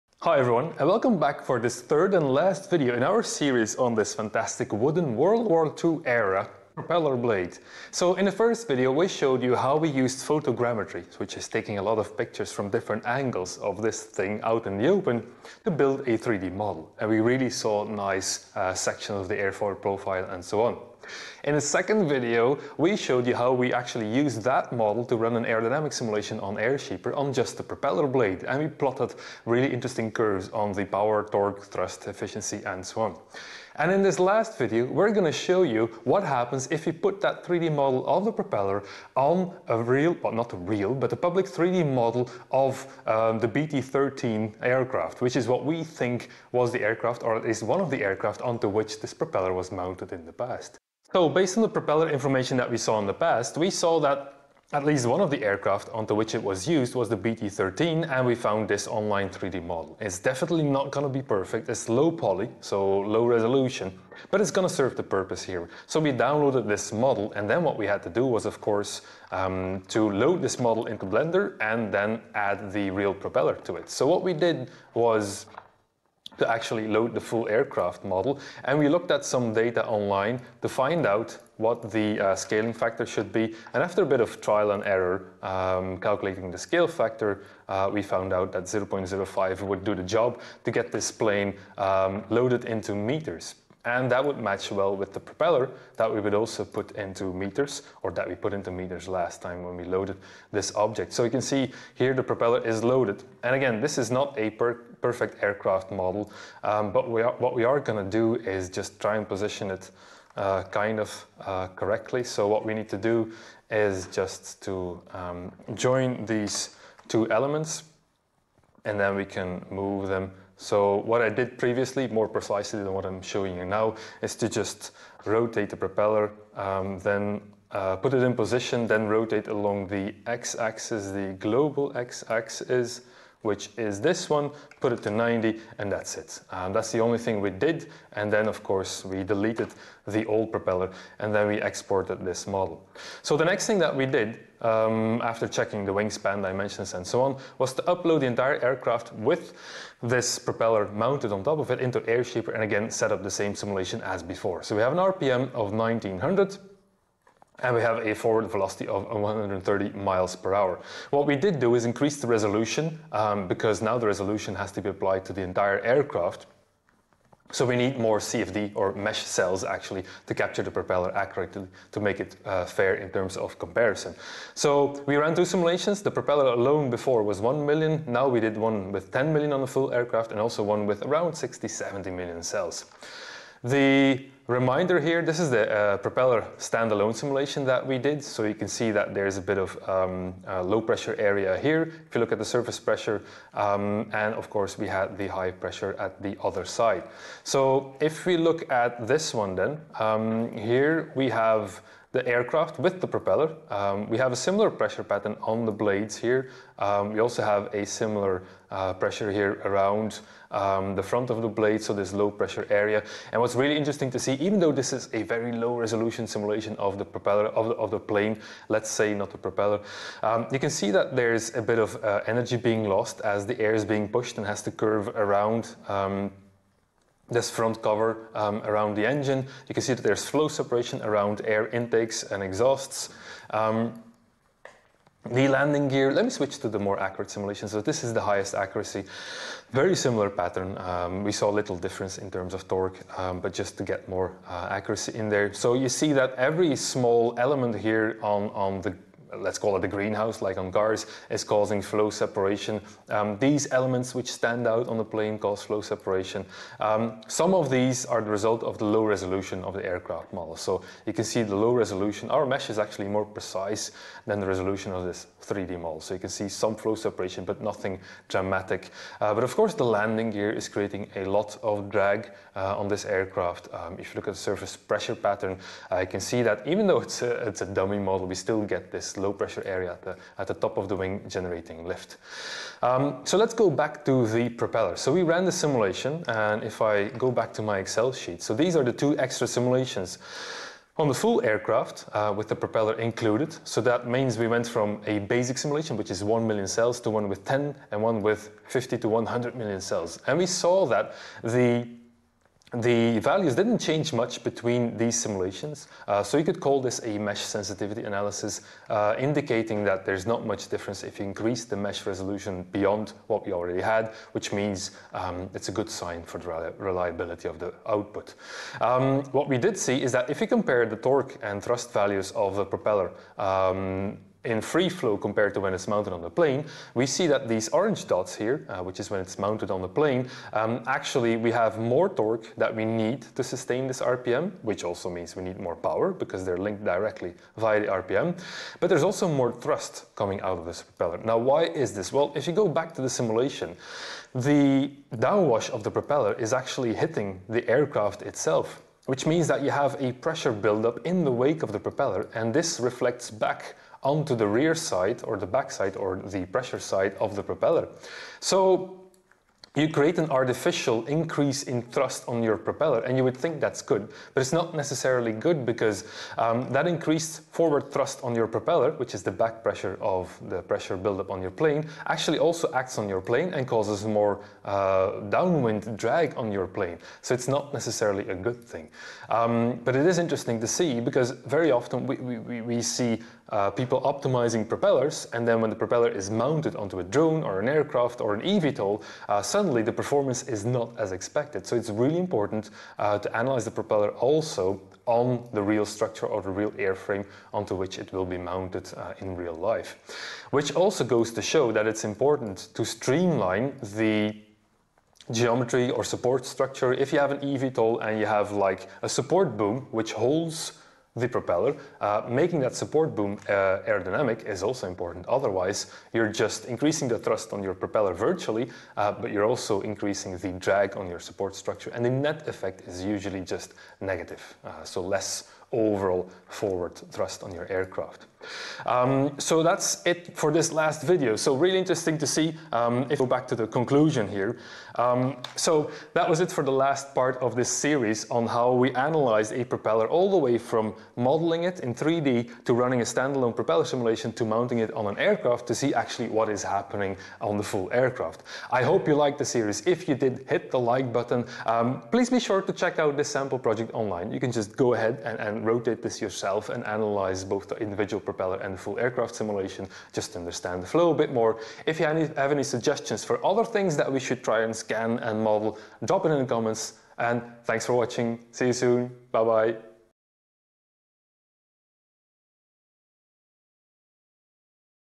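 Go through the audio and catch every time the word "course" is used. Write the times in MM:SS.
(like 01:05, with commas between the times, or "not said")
01:08, 02:18, 03:14, 04:29.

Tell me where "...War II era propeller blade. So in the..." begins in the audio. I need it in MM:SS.
00:05.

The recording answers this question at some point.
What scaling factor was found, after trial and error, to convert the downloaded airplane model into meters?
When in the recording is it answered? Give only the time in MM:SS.
01:28.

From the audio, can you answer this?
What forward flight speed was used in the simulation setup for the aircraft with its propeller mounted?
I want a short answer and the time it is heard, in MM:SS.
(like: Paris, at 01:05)
130 miles per hour, at 02:39.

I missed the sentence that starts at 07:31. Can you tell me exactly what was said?
Um, please be sure to check out this sample project online.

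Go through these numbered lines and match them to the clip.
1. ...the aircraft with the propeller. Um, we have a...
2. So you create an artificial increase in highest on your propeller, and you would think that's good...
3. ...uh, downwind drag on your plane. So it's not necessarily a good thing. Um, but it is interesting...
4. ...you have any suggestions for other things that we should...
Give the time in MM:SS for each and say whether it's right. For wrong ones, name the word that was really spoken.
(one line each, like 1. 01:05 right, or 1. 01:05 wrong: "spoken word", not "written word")
1. 03:22 right
2. 05:58 wrong: "thrust", not "highest"
3. 06:14 right
4. 07:41 right.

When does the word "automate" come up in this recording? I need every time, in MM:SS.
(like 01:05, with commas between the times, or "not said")
not said.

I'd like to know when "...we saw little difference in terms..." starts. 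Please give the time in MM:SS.
04:01.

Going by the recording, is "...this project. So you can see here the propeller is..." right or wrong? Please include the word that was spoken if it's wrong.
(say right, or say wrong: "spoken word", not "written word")
wrong: "object", not "project".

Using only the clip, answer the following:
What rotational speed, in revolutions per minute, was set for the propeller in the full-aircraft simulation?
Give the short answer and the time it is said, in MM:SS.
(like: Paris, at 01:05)
1900, at 02:35.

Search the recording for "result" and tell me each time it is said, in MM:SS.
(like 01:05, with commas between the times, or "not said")
04:18.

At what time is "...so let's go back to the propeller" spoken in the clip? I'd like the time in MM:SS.
04:43.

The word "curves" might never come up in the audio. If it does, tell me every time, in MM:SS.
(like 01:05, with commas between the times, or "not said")
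00:30, 03:44.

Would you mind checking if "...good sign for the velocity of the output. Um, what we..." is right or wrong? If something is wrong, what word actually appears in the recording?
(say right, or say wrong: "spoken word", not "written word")
wrong: "reliability", not "velocity".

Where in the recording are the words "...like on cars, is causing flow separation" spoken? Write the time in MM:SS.
04:10.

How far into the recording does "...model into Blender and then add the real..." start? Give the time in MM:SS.
01:10.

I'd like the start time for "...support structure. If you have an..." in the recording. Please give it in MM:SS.
06:46.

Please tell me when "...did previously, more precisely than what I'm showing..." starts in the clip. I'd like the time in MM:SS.
02:01.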